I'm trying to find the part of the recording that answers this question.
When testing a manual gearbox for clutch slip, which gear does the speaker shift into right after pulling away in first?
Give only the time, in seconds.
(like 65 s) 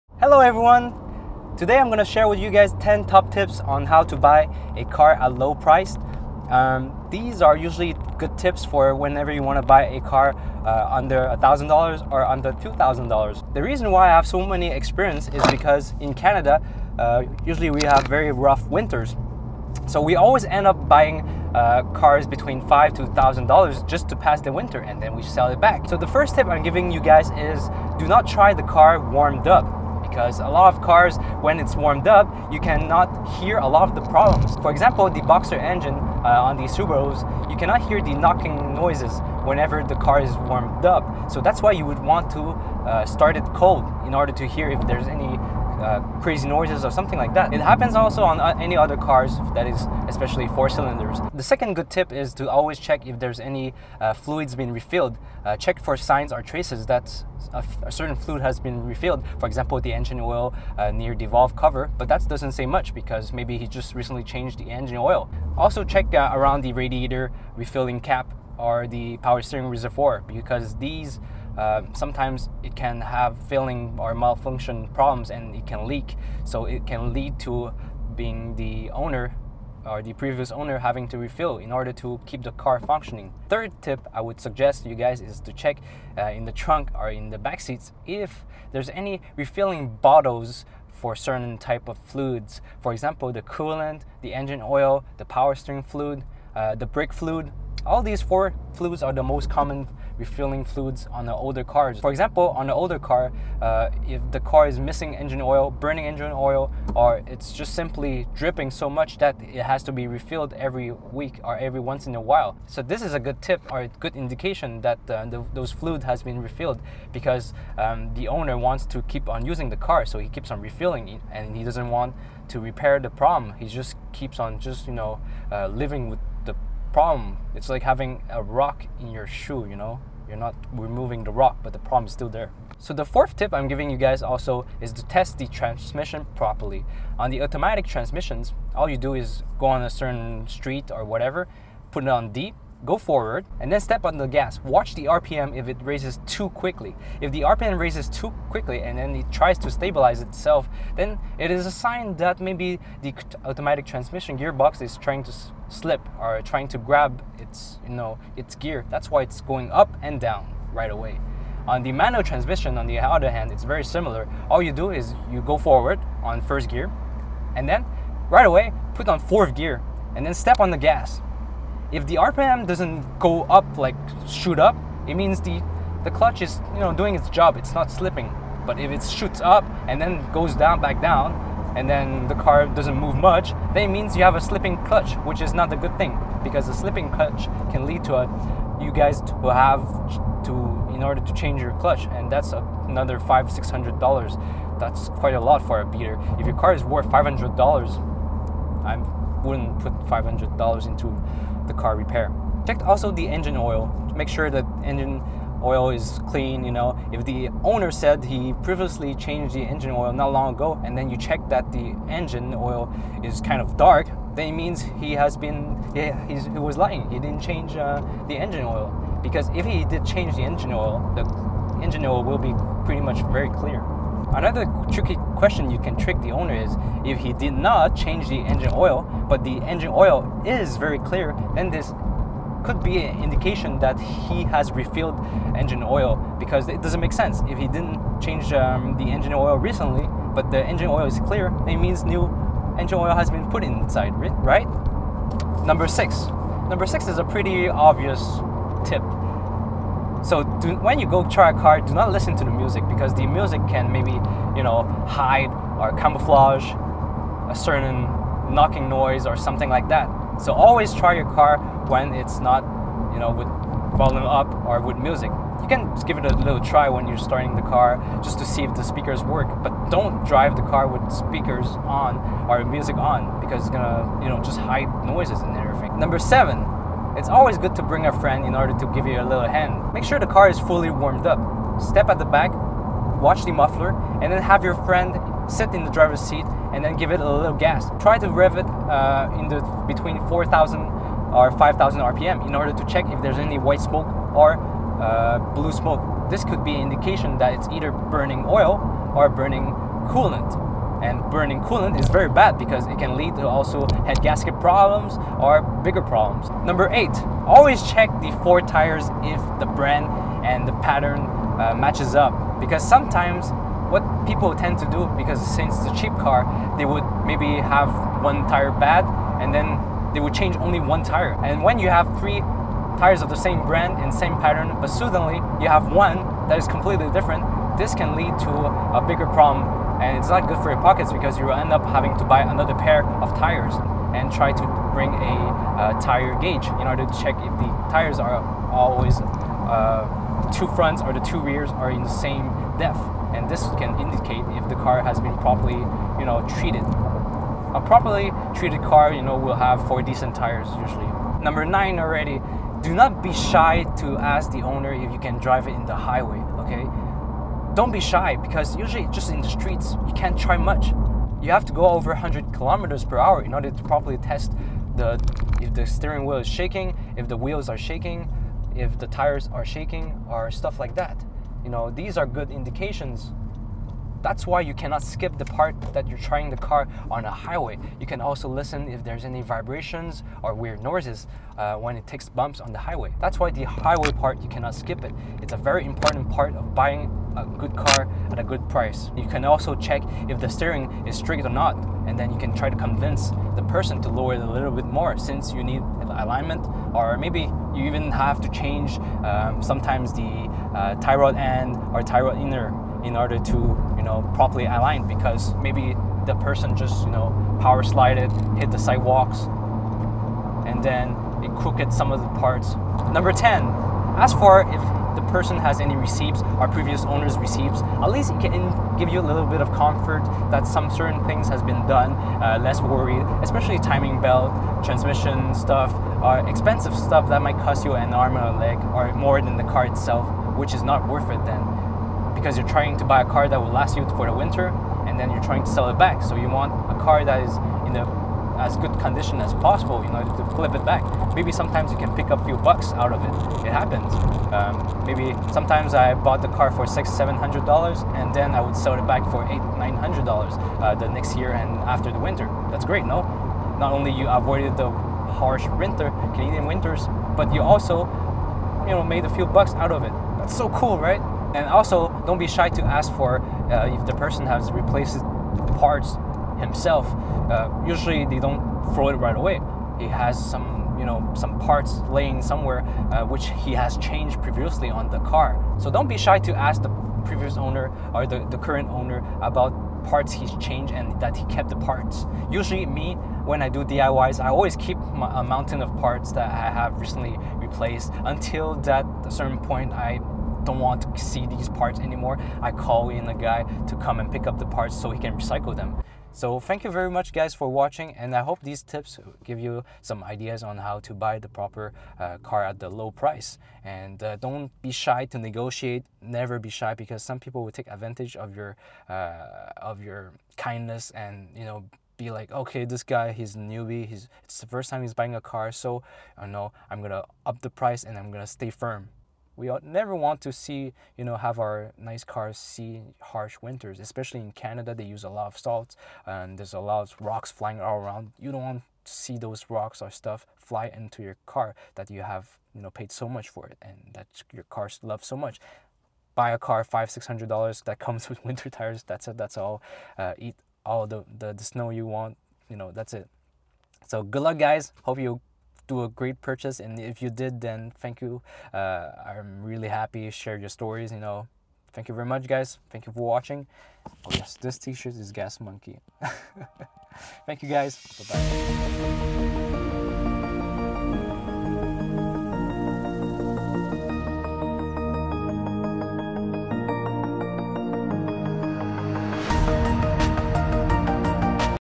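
169 s.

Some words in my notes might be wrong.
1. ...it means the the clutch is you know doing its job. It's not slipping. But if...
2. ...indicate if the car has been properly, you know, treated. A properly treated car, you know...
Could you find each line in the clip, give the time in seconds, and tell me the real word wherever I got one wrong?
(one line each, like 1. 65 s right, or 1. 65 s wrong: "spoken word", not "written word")
1. 175 s right
2. 343 s right.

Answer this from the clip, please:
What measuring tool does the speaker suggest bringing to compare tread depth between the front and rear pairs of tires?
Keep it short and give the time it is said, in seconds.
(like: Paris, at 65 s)
tire gauge, at 336 s.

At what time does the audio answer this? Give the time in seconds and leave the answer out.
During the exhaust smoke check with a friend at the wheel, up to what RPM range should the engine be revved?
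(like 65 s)
290 s.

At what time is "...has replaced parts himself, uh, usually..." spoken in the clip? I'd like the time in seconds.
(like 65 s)
464 s.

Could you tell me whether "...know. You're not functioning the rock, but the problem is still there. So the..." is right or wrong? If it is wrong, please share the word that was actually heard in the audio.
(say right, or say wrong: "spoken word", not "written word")
wrong: "removing", not "functioning".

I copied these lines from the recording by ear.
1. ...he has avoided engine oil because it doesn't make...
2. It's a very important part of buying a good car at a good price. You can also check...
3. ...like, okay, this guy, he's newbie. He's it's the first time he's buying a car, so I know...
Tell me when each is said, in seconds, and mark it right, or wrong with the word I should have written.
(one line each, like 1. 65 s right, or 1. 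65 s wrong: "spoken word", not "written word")
1. 233 s wrong: "refilled", not "avoided"
2. 385 s right
3. 512 s right.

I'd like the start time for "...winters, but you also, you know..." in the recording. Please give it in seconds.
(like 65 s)
456 s.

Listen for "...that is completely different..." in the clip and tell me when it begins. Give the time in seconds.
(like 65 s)
326 s.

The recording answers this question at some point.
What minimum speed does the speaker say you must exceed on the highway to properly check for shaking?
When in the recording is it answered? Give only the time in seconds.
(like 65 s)
362 s.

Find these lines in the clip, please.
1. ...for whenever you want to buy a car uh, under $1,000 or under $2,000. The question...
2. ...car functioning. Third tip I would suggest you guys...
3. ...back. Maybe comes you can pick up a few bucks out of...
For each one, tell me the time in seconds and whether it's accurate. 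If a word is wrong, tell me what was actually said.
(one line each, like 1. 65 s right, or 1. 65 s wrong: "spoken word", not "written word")
1. 8 s wrong: "reason", not "question"
2. 82 s right
3. 440 s wrong: "sometimes", not "comes".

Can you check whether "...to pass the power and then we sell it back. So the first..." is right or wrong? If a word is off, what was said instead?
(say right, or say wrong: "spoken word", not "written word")
wrong: "winter", not "power".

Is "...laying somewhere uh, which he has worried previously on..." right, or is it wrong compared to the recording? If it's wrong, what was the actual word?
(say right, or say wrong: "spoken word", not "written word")
wrong: "changed", not "worried".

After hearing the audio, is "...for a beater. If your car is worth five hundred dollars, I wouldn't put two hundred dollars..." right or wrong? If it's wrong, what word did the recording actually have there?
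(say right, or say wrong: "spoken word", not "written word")
wrong: "five", not "two".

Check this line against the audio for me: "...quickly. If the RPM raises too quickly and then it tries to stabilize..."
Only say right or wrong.
right.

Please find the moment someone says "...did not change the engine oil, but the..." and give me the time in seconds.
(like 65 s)
227 s.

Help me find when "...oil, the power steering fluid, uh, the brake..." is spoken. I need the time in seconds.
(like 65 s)
94 s.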